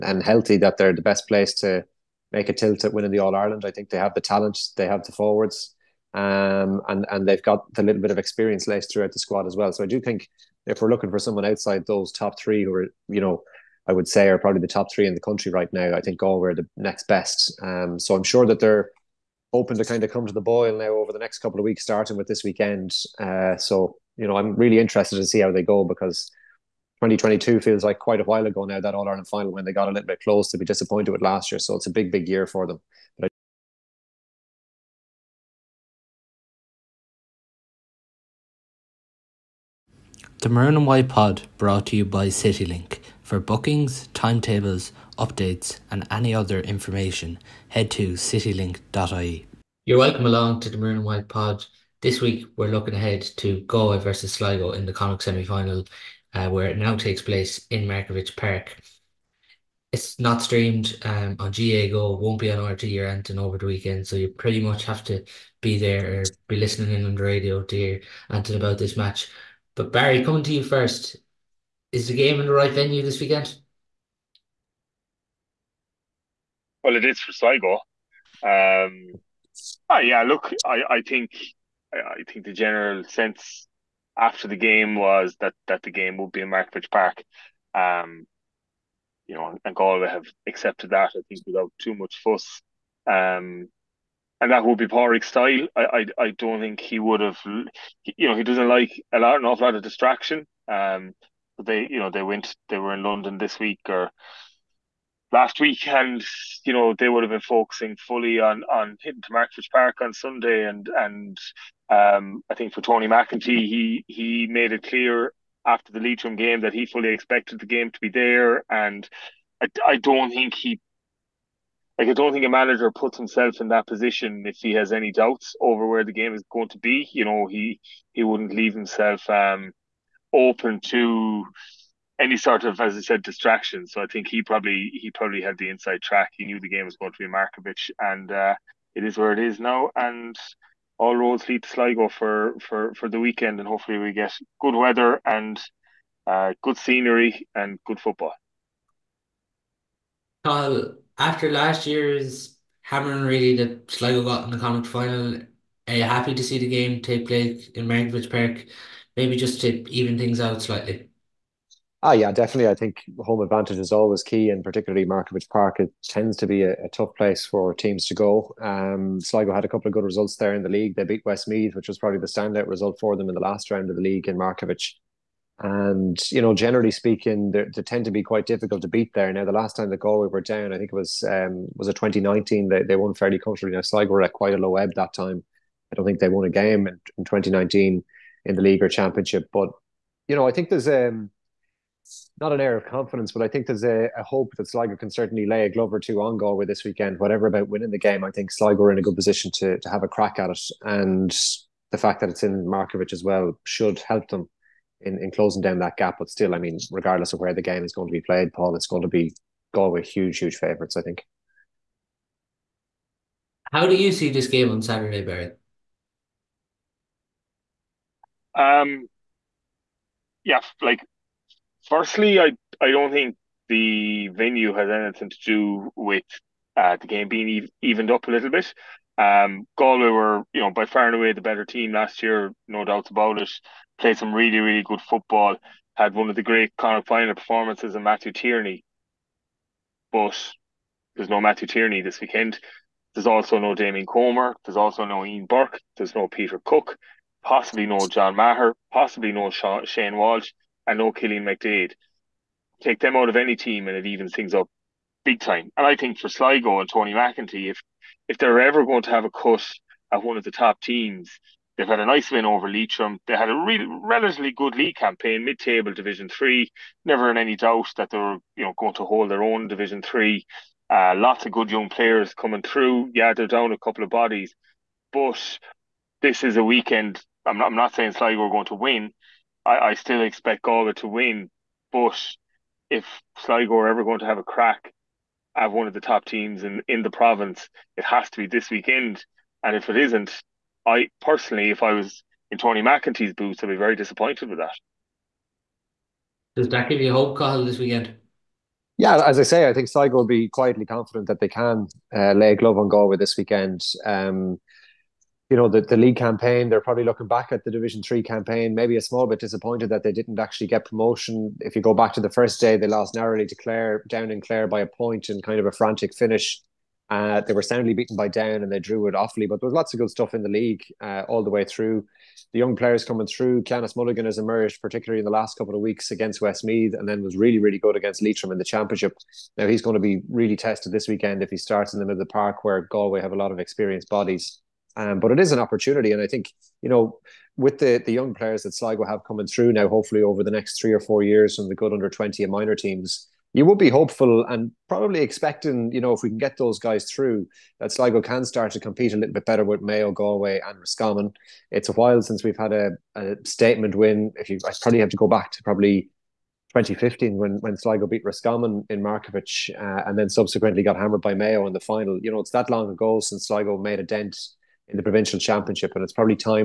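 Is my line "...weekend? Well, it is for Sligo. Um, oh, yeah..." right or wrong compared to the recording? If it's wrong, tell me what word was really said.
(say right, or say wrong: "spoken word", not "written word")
right.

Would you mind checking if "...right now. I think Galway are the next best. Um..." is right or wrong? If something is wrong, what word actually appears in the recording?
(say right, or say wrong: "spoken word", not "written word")
right.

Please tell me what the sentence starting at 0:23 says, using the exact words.
Uh, so you know, I'm really interested to see how they go because 2022 feels like quite a while ago now.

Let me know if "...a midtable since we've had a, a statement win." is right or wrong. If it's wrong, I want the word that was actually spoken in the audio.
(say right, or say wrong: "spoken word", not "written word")
wrong: "while", not "midtable".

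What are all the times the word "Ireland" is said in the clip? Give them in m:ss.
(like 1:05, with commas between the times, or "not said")
0:03, 0:29.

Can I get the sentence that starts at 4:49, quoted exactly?
And if it isn't, I personally, if I was in Tony McEntee's boots, I'd be very disappointed with that.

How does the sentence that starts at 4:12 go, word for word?
Take them out of any team and it evens things up big time.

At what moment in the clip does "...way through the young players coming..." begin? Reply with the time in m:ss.
5:21.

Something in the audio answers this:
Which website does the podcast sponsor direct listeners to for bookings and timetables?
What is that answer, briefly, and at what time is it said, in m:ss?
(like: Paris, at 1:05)
citylink.ie, at 0:48.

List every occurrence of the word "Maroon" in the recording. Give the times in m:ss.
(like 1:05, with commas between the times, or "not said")
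0:40, 0:50.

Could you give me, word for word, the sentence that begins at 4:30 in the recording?
Uh, lots of good young players coming through.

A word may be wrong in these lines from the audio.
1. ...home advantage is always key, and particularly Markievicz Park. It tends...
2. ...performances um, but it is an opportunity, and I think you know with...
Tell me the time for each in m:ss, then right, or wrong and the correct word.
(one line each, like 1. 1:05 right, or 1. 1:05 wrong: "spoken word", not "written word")
1. 2:43 right
2. 5:34 wrong: "bodies", not "performances".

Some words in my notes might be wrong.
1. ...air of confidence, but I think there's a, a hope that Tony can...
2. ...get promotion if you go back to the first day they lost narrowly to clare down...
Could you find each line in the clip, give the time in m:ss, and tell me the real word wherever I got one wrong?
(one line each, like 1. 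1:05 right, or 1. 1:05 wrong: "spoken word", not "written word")
1. 3:12 wrong: "Sligo", not "Tony"
2. 5:10 right.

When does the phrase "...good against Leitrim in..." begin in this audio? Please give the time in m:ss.
5:27.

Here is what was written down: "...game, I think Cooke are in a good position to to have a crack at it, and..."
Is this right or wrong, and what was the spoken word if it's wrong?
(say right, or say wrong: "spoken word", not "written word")
wrong: "Sligo", not "Cooke".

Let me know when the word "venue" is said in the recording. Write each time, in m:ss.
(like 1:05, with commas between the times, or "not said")
1:12, 3:44.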